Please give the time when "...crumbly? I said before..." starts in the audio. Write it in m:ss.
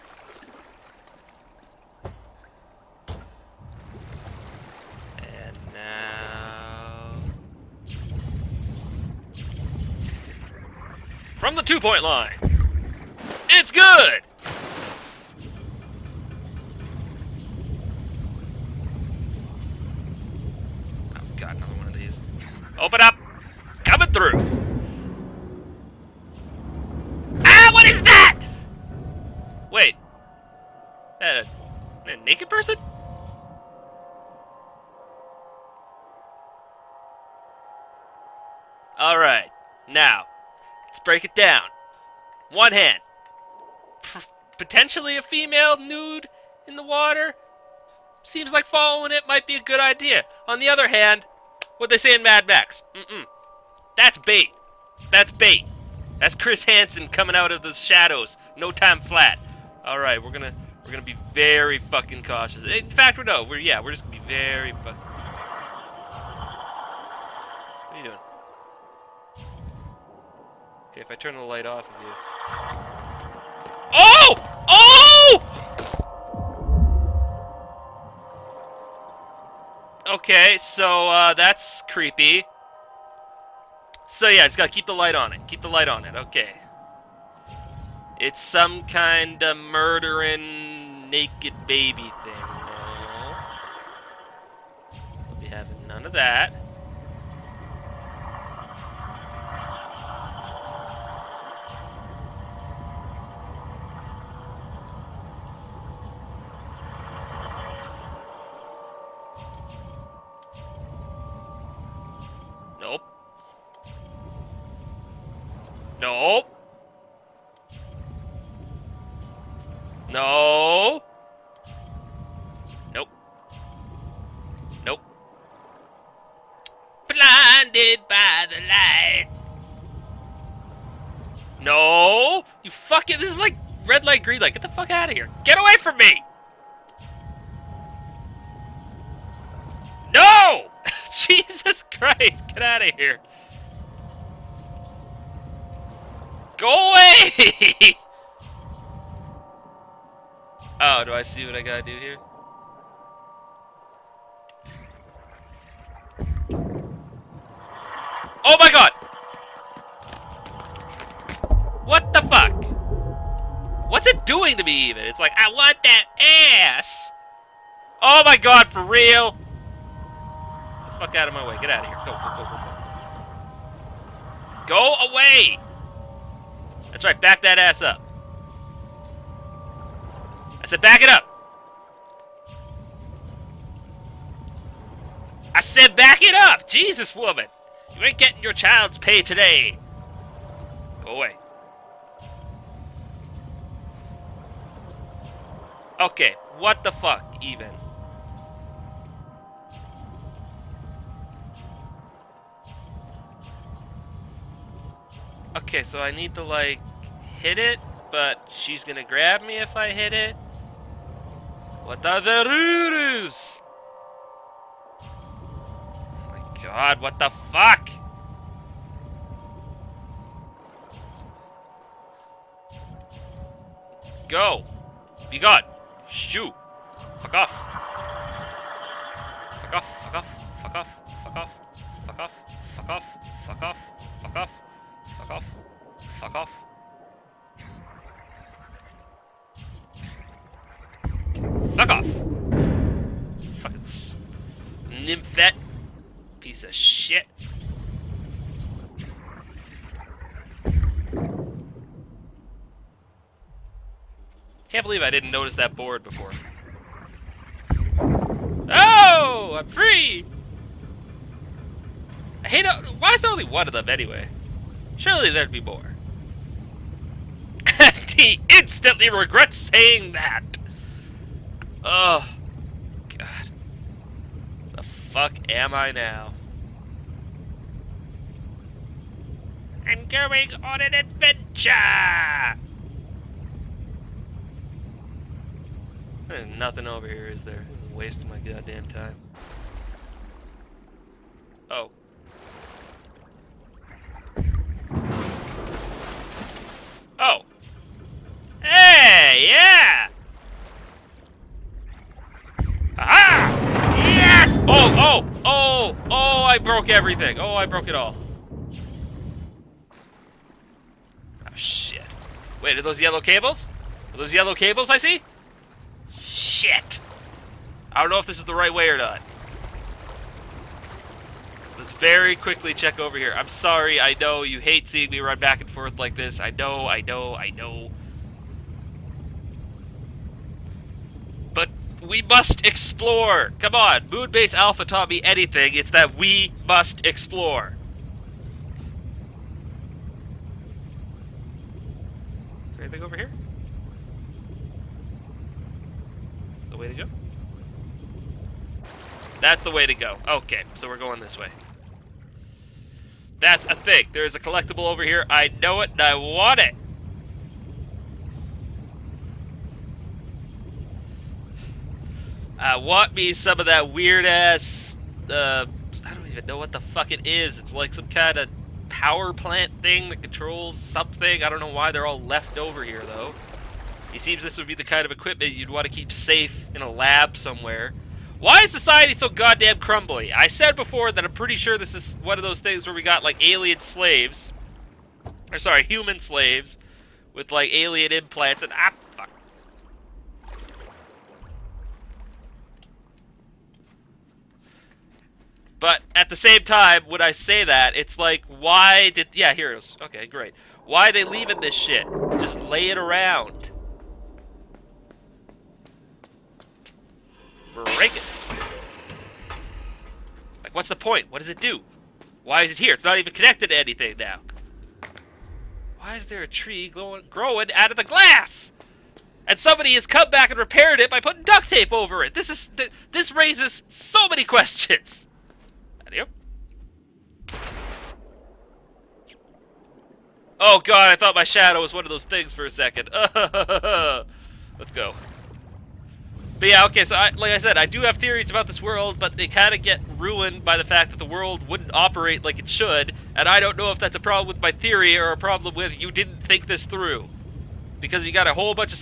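6:19.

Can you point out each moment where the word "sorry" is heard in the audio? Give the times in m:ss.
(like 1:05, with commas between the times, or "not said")
5:23, 6:25.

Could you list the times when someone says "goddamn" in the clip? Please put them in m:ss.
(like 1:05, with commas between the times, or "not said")
4:48, 6:19.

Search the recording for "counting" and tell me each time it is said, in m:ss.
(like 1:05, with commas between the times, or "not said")
not said.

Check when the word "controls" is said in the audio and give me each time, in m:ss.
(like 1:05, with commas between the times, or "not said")
6:10.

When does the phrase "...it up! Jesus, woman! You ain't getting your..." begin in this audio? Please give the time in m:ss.
3:06.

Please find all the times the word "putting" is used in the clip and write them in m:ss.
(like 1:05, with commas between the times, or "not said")
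7:01.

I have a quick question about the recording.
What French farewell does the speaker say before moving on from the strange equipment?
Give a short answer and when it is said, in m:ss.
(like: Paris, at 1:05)
Adieu, at 7:06.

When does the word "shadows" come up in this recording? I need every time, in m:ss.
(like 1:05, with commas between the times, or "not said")
0:57, 7:11.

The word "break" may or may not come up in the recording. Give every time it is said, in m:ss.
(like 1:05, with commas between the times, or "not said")
0:40, 6:47.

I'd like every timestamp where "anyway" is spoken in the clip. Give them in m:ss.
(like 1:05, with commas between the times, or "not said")
4:23.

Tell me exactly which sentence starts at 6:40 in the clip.
Why are they leaving this shit?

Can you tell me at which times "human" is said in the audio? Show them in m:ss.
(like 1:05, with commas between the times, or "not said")
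6:25.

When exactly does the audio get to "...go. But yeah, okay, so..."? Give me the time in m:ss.
7:14.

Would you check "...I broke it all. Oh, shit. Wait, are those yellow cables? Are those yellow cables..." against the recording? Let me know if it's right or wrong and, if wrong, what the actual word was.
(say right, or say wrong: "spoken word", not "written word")
right.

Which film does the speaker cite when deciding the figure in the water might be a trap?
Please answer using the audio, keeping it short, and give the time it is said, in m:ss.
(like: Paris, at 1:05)
Mad Max, at 0:52.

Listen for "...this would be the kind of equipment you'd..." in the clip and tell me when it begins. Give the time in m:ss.
6:14.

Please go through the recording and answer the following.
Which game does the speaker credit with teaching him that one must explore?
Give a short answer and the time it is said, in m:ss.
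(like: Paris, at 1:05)
Moonbase Alpha, at 5:34.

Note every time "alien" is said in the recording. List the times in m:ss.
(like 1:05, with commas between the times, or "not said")
6:23, 6:27.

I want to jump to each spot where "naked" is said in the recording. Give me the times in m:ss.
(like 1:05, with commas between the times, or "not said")
0:32, 1:31.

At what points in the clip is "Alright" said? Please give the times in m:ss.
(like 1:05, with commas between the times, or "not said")
0:38, 0:59.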